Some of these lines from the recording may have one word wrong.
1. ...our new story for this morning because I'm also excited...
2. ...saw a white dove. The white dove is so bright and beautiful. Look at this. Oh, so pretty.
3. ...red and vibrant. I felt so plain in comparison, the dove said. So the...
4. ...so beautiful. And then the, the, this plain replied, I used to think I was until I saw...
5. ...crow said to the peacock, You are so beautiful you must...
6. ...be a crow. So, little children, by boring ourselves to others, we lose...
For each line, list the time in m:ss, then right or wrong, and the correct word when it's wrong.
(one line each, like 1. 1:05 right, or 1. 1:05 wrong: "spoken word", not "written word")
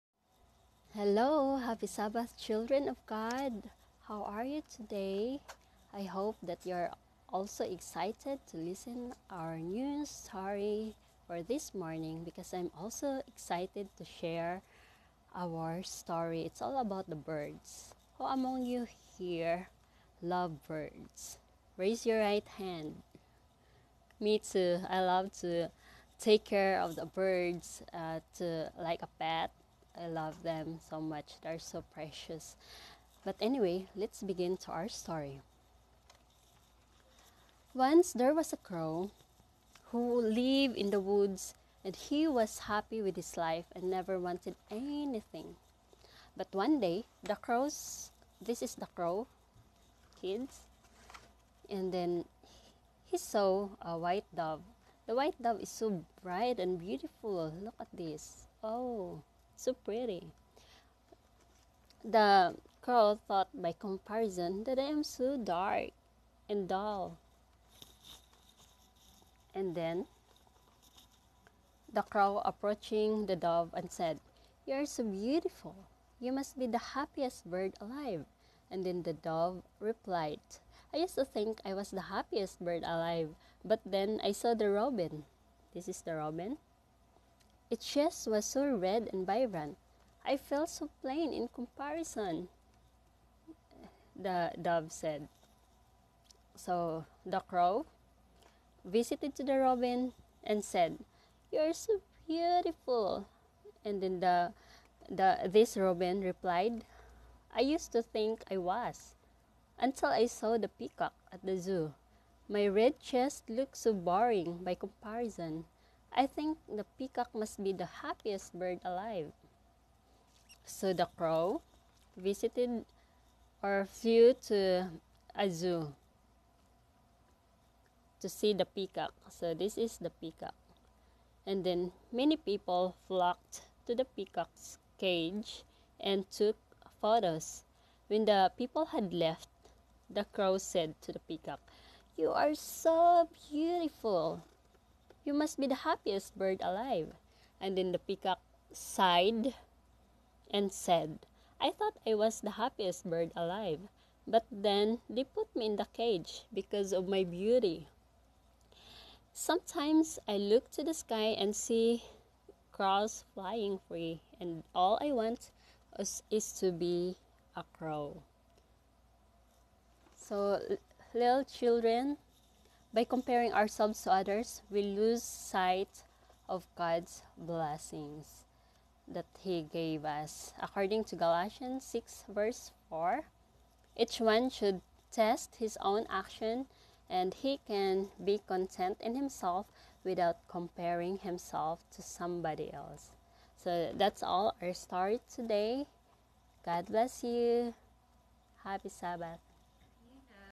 1. 0:09 right
2. 0:53 right
3. 1:28 right
4. 1:41 wrong: "robin", not "plain"
5. 2:20 right
6. 2:46 wrong: "comparing", not "boring".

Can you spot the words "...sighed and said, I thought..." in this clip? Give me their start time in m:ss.
2:28.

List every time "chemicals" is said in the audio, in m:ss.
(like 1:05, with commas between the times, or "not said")
not said.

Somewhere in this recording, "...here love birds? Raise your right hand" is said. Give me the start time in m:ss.
0:19.